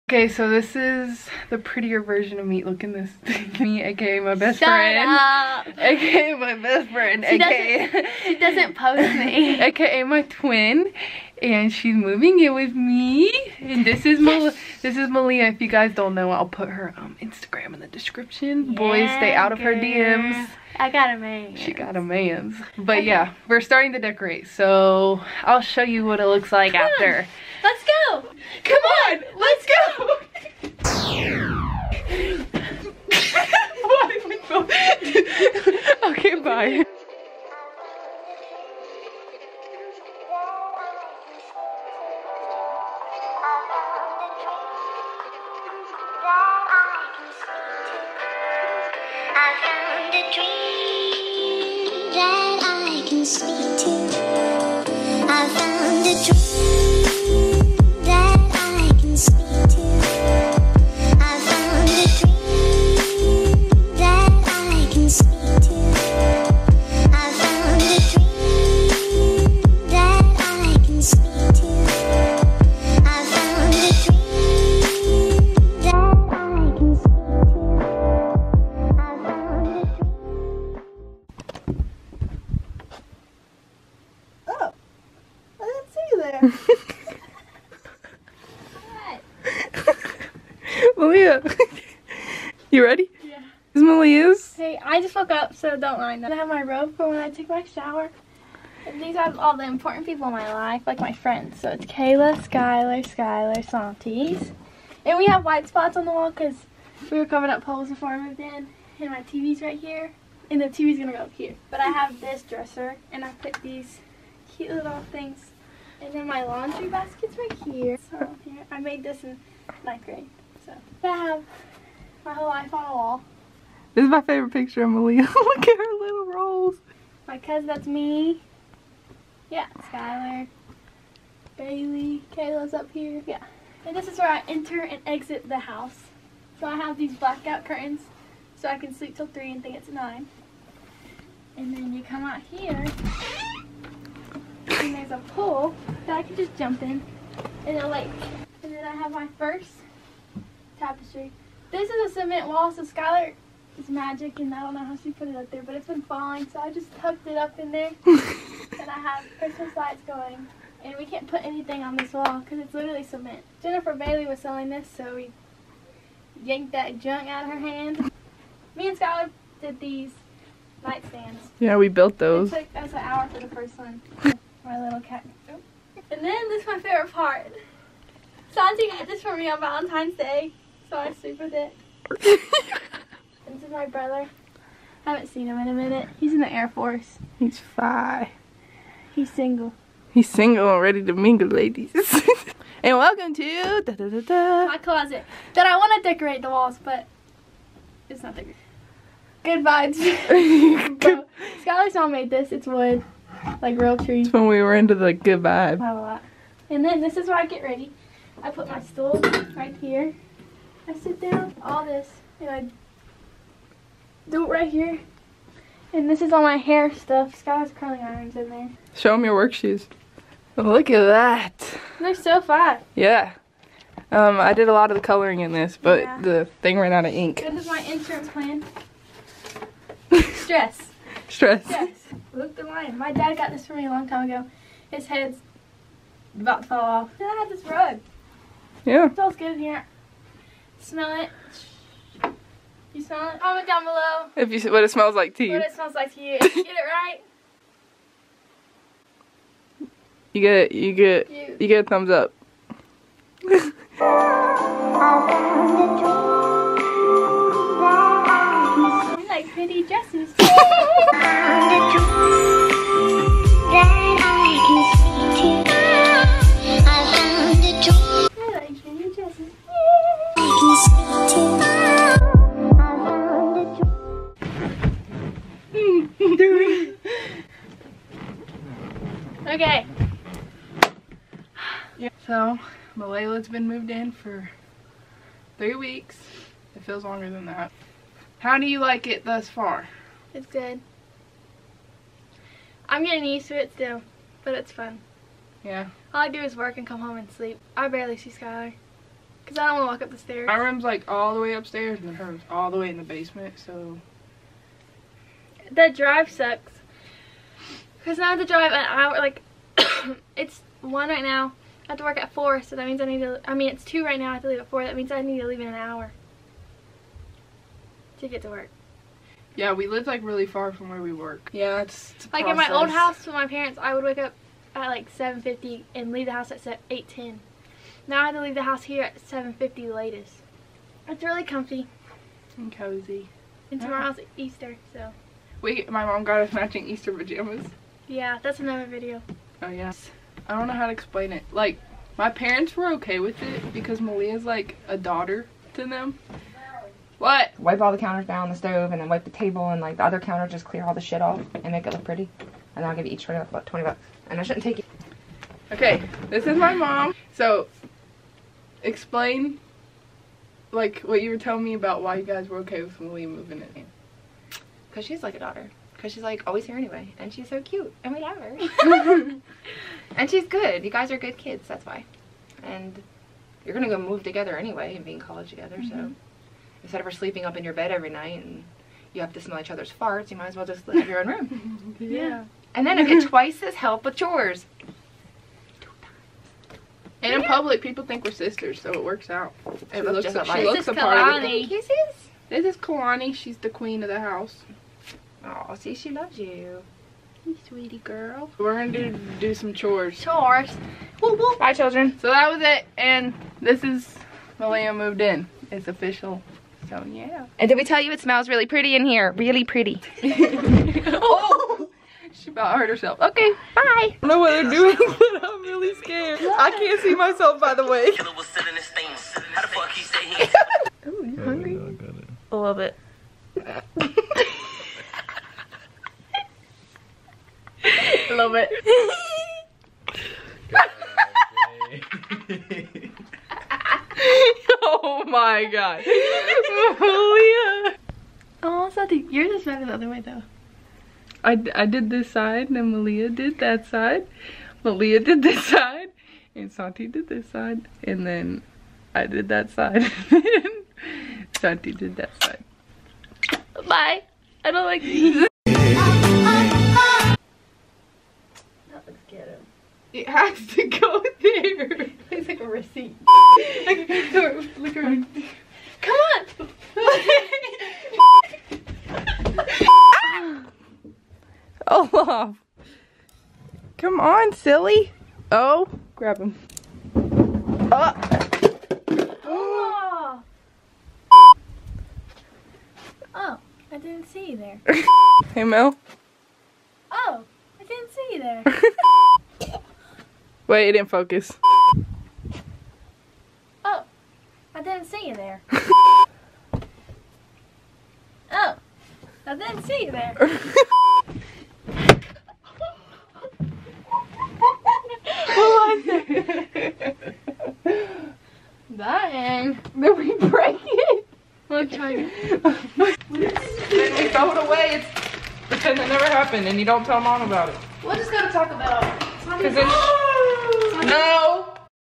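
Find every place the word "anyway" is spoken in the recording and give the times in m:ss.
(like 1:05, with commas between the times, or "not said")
6:06, 6:14.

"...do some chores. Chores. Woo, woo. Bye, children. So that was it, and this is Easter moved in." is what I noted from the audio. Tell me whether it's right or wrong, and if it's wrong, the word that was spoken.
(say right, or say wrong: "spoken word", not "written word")
wrong: "Malia", not "Easter".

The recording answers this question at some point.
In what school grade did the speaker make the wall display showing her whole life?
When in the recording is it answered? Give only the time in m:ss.
1:59.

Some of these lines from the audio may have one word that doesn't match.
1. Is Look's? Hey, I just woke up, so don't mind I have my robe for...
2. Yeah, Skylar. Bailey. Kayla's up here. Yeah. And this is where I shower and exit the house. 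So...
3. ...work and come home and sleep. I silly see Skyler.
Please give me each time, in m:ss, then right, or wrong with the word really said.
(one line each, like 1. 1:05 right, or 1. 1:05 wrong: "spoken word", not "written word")
1. 1:33 wrong: "Malia", not "Look"
2. 2:09 wrong: "enter", not "shower"
3. 4:56 wrong: "barely", not "silly".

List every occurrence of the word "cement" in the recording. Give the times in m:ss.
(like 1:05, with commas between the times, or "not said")
2:32, 2:43.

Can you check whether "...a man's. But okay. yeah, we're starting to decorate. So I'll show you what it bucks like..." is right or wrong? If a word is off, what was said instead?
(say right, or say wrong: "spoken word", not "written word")
wrong: "looks", not "bucks".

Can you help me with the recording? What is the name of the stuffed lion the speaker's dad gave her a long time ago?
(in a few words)
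Luke the Lion.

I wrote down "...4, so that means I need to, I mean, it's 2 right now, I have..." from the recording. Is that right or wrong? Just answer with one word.
right.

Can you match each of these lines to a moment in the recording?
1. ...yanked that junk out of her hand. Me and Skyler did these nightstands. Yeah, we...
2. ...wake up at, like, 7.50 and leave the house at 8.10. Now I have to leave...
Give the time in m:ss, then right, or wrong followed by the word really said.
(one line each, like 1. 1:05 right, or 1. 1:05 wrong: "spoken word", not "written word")
1. 2:46 right
2. 5:24 right.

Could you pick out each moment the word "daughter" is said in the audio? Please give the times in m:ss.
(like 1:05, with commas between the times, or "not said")
5:44, 6:05.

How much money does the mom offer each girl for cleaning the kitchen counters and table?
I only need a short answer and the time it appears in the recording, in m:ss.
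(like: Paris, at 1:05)
$20, at 5:53.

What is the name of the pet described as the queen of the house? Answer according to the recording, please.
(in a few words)
Kalani.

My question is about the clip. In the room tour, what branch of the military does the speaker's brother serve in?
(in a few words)
Air Force.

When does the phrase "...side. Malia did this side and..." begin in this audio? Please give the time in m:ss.
7:23.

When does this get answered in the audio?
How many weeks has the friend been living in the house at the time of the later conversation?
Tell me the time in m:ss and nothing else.
4:45.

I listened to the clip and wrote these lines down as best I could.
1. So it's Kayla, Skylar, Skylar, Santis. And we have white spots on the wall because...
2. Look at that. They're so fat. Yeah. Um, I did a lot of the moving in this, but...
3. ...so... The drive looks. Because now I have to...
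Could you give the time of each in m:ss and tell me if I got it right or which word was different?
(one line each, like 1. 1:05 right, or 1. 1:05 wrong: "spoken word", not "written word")
1. 1:41 right
2. 3:40 wrong: "coloring", not "moving"
3. 5:03 wrong: "sucks", not "looks".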